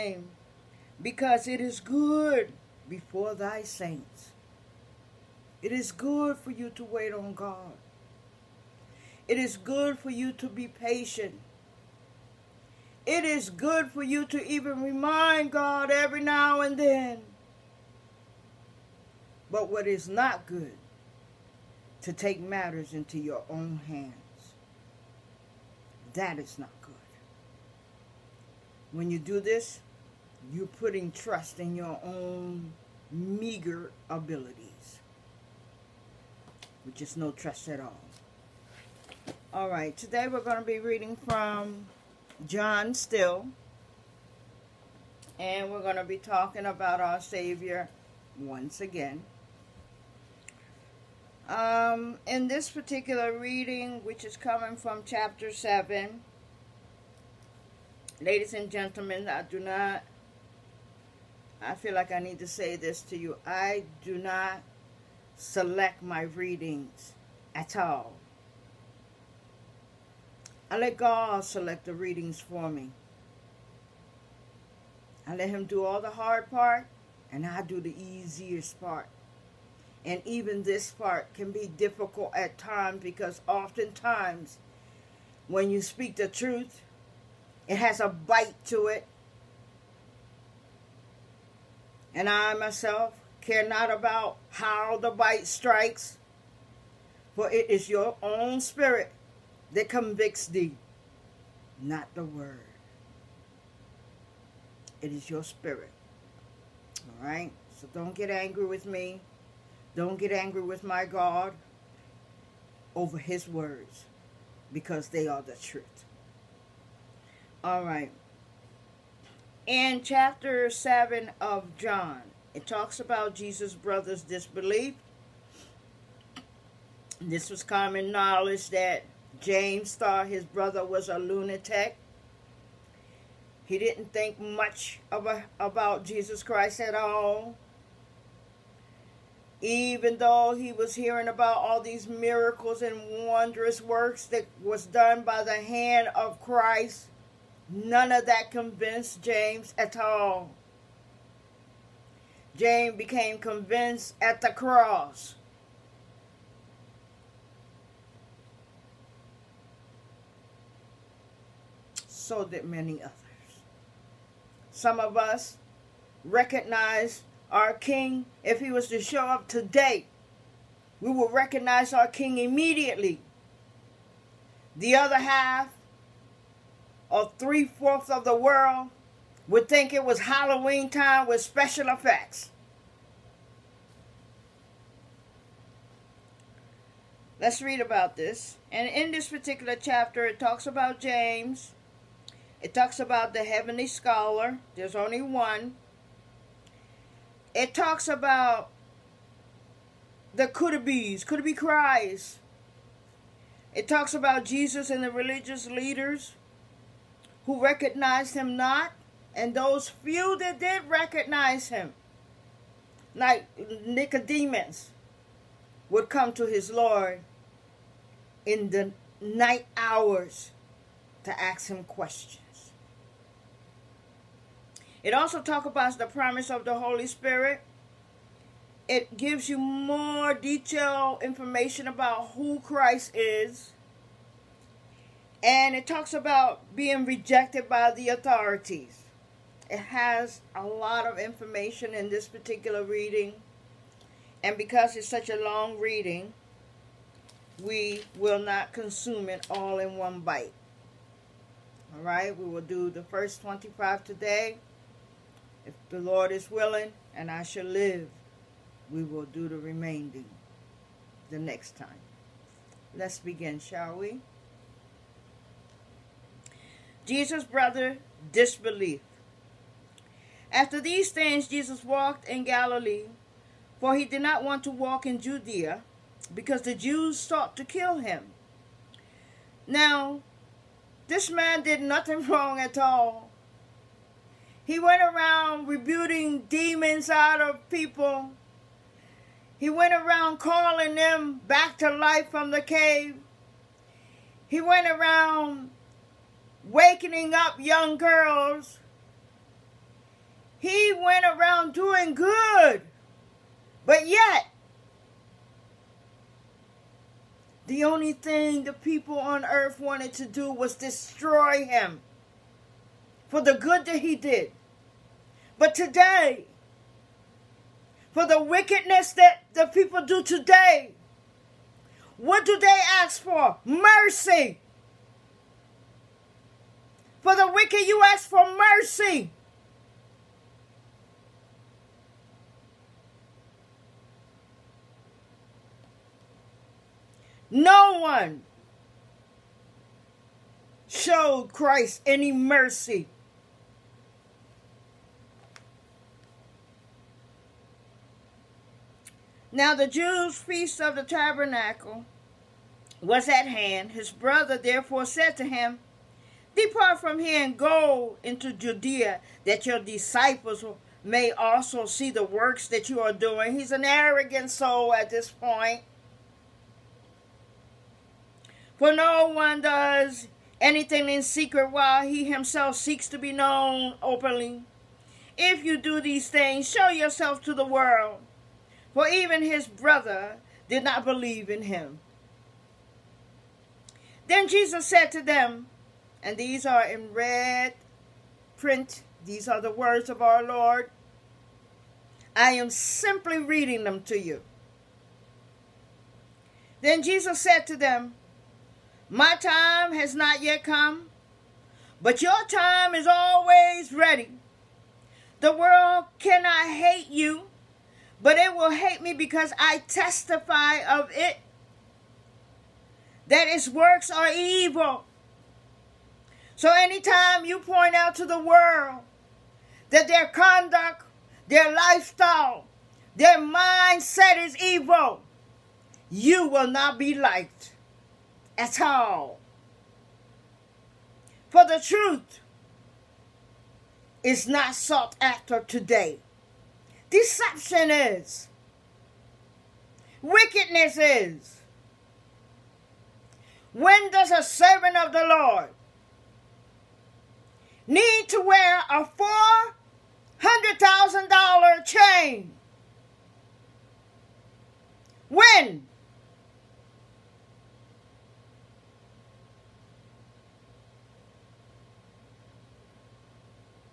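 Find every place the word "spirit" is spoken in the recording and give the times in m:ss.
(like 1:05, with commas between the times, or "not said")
1:38, 1:45, 3:47.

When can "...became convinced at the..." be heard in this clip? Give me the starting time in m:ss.
2:32.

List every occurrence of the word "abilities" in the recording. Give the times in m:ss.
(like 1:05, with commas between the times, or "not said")
0:34.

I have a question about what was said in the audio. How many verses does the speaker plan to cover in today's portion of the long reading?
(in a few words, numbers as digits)
25.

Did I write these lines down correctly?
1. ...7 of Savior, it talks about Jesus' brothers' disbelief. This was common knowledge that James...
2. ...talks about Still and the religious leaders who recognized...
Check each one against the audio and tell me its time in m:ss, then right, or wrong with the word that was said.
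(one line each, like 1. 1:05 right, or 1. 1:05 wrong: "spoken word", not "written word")
1. 2:00 wrong: "John", not "Savior"
2. 3:23 wrong: "Jesus", not "Still".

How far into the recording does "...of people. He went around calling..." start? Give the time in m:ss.
4:47.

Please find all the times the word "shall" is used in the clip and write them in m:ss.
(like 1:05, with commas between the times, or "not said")
4:17, 4:23.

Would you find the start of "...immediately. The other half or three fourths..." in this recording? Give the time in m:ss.
2:52.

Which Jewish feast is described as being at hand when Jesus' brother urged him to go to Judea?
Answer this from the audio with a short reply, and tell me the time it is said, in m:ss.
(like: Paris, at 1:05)
Feast of the tabernacle, at 5:50.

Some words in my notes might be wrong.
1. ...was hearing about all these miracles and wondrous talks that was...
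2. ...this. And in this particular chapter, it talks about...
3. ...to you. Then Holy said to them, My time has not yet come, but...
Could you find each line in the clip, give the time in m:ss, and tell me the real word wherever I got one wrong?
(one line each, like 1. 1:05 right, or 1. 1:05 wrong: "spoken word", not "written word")
1. 2:20 wrong: "works", not "talks"
2. 3:08 right
3. 6:34 wrong: "Jesus", not "Holy".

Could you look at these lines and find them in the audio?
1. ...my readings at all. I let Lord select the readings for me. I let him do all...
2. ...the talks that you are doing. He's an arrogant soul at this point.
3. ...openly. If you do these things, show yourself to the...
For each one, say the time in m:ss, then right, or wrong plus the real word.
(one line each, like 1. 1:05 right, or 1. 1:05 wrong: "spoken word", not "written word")
1. 1:06 wrong: "God", not "Lord"
2. 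6:02 wrong: "works", not "talks"
3. 6:14 right.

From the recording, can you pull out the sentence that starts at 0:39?
All right, today we're going to be reading from John Still, and we're going to be talking about our Savior once again.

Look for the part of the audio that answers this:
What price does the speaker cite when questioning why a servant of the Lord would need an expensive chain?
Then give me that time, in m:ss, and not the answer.
7:30.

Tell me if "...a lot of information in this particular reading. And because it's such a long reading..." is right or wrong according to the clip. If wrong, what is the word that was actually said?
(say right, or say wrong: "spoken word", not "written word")
right.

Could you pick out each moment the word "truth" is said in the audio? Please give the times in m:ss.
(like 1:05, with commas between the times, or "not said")
1:26, 1:55, 7:11.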